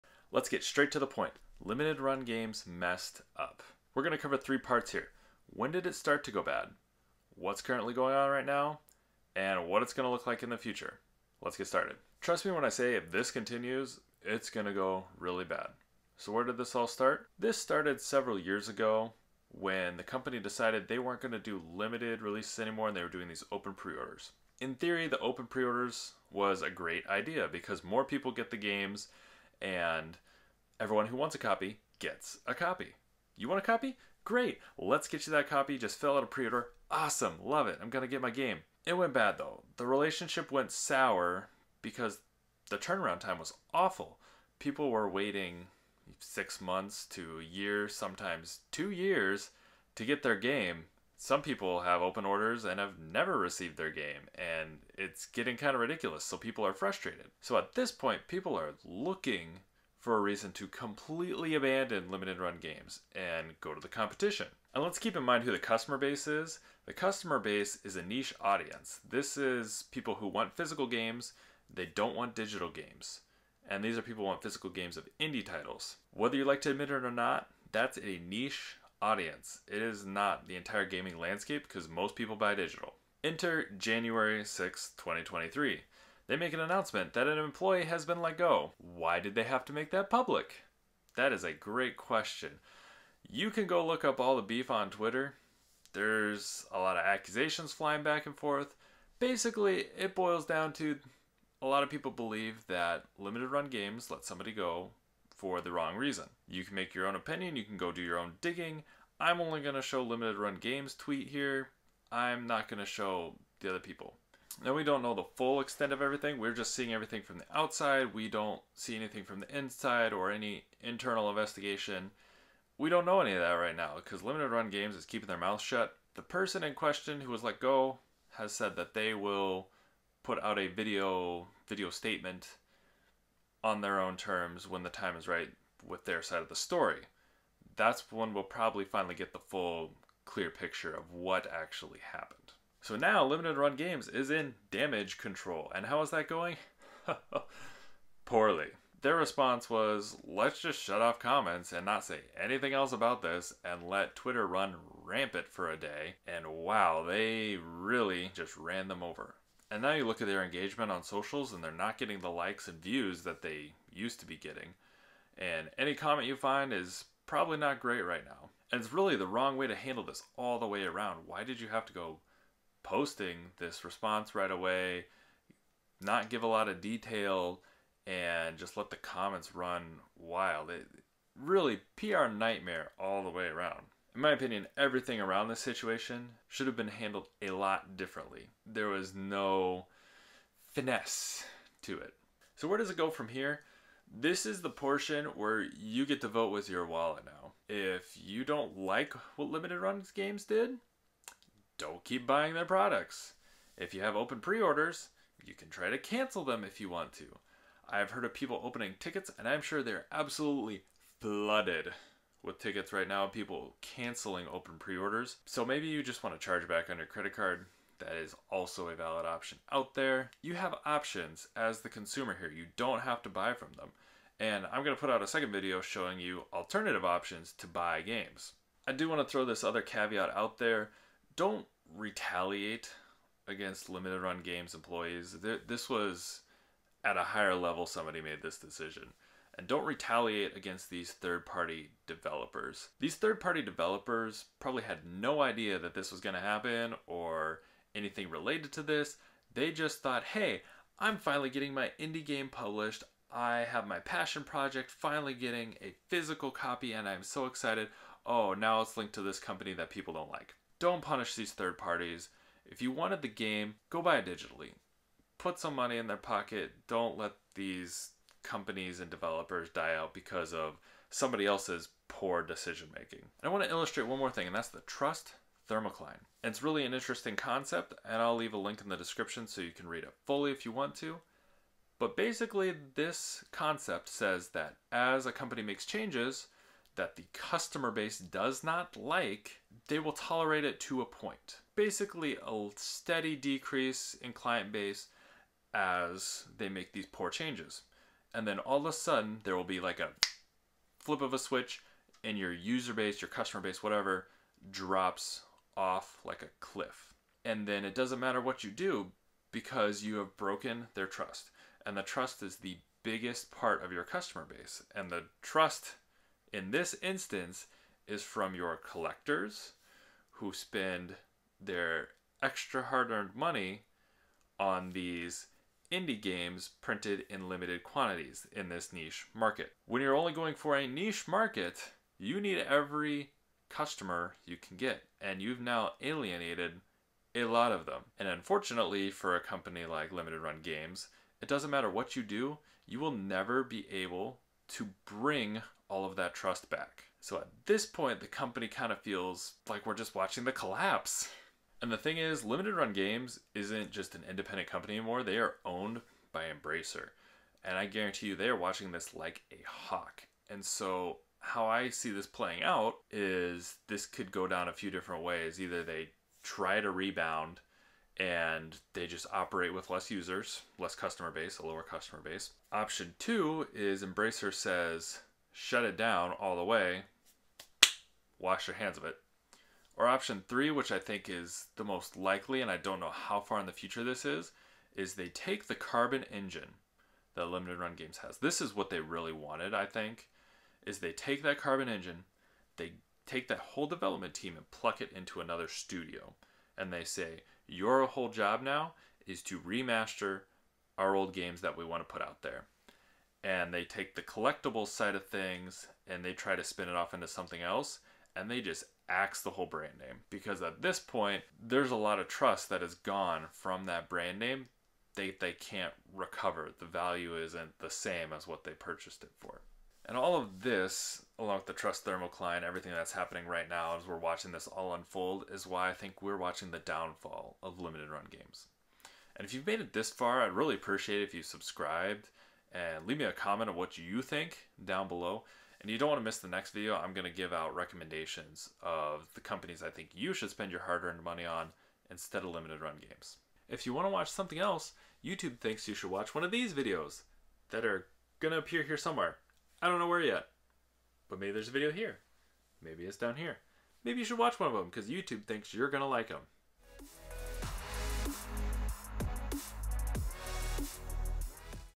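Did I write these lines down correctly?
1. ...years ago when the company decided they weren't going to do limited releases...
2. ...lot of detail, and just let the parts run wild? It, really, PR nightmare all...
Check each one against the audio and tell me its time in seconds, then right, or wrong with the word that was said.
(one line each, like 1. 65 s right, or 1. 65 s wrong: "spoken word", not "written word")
1. 18 s right
2. 176 s wrong: "comments", not "parts".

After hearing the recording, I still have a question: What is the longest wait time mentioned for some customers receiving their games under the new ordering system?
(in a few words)
2 years.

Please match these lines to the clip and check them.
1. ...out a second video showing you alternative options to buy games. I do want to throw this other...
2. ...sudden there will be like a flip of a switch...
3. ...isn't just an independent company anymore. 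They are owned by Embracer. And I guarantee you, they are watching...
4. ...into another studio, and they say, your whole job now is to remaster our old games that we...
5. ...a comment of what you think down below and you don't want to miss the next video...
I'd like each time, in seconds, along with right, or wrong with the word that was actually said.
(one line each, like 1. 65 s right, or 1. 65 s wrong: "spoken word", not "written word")
1. 225 s right
2. 298 s right
3. 353 s right
4. 395 s right
5. 433 s right.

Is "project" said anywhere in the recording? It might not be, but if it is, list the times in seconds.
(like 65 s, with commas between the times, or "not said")
254 s.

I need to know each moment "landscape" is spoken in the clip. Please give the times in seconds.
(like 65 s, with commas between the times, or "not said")
81 s.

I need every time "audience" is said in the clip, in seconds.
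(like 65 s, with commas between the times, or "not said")
68 s, 79 s.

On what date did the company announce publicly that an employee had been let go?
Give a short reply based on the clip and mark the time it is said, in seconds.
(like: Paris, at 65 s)
January 6, 2023, at 83 s.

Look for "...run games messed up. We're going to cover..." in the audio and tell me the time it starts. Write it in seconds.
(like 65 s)
1 s.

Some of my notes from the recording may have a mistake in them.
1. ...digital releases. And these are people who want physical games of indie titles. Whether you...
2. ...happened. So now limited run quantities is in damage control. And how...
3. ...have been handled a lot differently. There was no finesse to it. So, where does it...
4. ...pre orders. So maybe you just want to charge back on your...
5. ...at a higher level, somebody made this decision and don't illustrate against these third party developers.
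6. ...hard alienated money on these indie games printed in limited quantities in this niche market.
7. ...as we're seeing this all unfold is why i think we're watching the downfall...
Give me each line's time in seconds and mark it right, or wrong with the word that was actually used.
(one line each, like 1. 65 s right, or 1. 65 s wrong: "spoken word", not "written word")
1. 72 s wrong: "games", not "releases"
2. 142 s wrong: "games", not "quantities"
3. 186 s right
4. 214 s right
5. 237 s wrong: "retaliate", not "illustrate"
6. 322 s wrong: "earned", not "alienated"
7. 423 s wrong: "watching", not "seeing".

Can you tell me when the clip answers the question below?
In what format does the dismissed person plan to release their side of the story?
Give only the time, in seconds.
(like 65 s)
131 s.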